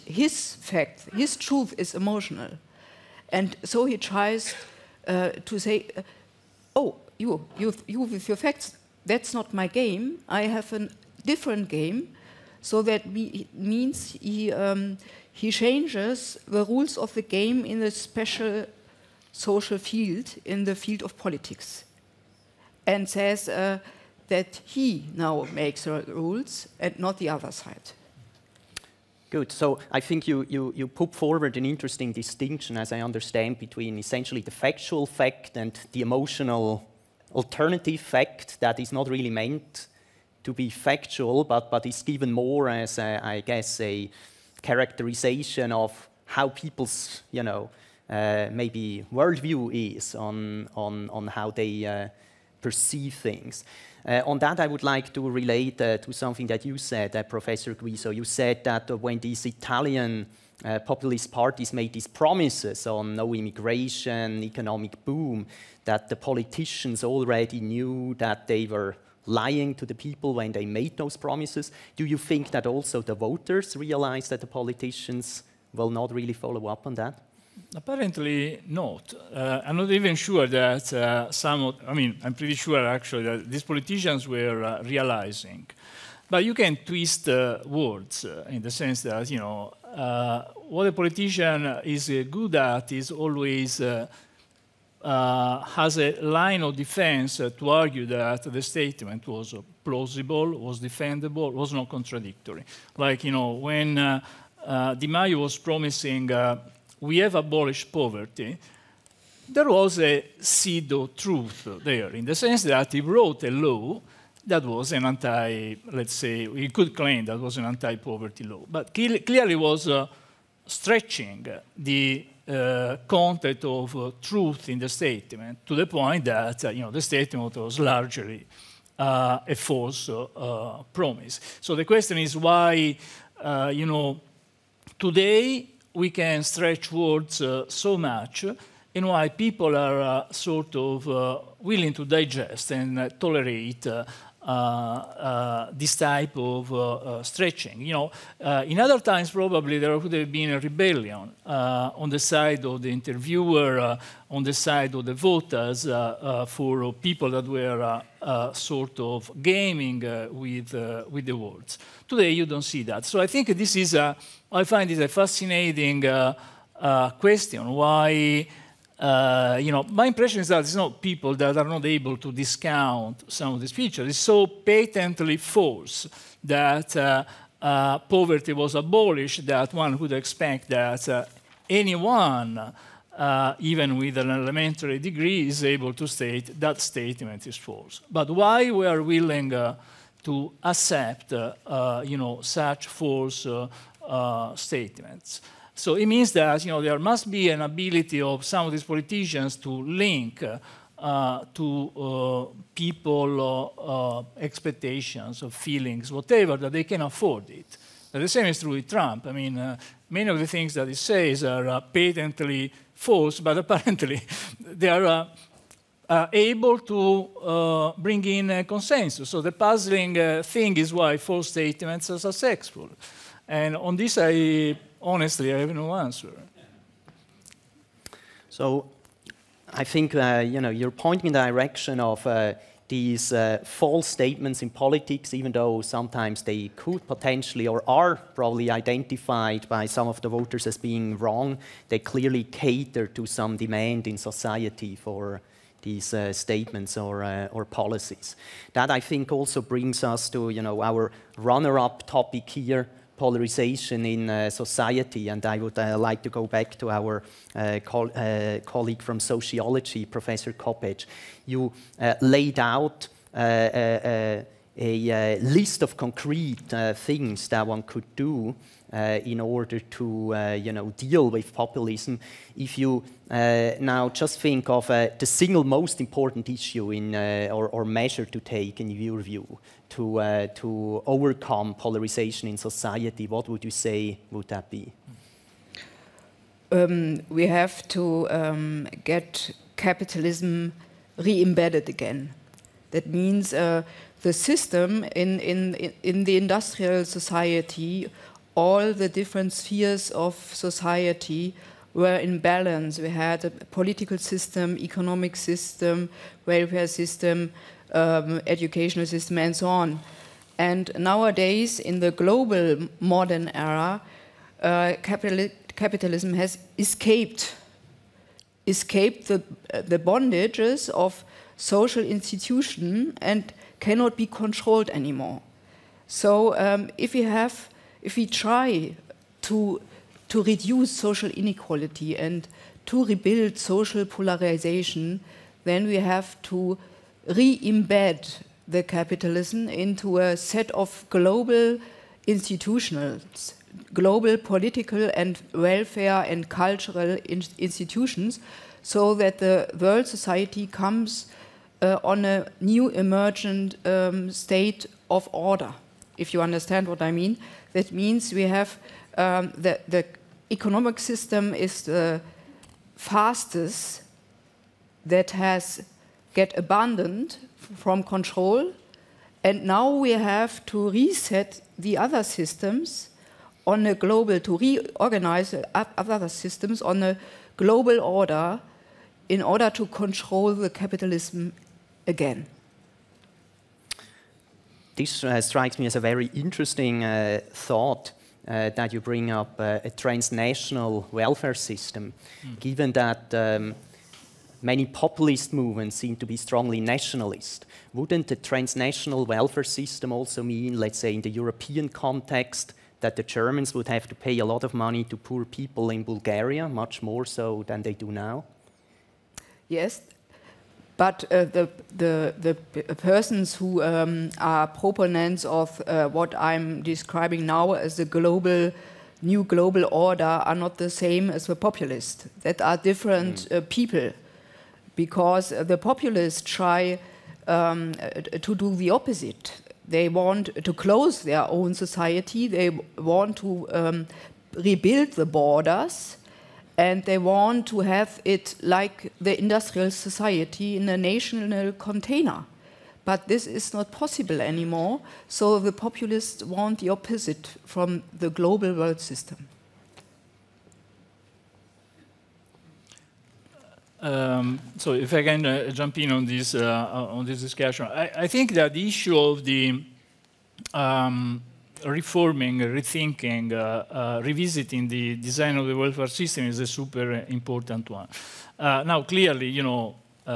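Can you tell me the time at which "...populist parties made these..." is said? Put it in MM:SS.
01:00.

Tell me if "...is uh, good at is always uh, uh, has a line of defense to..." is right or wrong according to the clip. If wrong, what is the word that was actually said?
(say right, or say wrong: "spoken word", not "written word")
right.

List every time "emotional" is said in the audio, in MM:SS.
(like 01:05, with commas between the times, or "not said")
00:01, 00:36.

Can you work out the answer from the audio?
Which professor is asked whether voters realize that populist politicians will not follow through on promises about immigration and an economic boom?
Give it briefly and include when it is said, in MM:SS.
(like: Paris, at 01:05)
Professor Guiso, at 00:57.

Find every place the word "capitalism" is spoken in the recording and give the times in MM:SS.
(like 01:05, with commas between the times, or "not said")
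04:49, 05:15, 05:38, 06:20.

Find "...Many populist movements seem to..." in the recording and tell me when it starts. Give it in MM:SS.
06:34.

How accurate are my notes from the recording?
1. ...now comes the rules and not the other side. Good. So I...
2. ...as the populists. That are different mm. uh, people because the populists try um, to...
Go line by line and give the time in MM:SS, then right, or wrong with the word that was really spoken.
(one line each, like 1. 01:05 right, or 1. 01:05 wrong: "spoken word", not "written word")
1. 00:25 wrong: "makes", not "comes"
2. 07:01 right.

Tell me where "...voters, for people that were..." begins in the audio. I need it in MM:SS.
02:35.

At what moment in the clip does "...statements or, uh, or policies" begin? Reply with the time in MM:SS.
04:06.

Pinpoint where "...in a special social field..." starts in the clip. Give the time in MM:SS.
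00:17.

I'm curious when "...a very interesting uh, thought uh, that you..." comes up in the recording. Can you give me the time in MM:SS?
06:25.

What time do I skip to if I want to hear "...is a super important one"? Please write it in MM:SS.
07:46.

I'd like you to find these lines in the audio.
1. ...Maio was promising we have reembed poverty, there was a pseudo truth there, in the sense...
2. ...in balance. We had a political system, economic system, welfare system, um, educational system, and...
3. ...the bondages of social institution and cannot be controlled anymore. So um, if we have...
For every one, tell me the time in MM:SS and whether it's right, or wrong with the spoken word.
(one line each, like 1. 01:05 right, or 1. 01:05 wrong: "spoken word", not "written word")
1. 01:45 wrong: "abolished", not "reembed"
2. 05:02 right
3. 05:19 right.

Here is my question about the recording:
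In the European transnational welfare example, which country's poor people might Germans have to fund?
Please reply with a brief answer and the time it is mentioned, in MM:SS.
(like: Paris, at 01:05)
Bulgaria, at 06:46.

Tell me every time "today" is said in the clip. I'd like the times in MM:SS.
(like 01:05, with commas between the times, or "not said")
02:14, 02:42.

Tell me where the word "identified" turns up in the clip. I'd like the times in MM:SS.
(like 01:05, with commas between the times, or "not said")
03:58.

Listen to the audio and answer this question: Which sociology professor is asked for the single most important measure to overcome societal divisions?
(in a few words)
Professor Koppetsch.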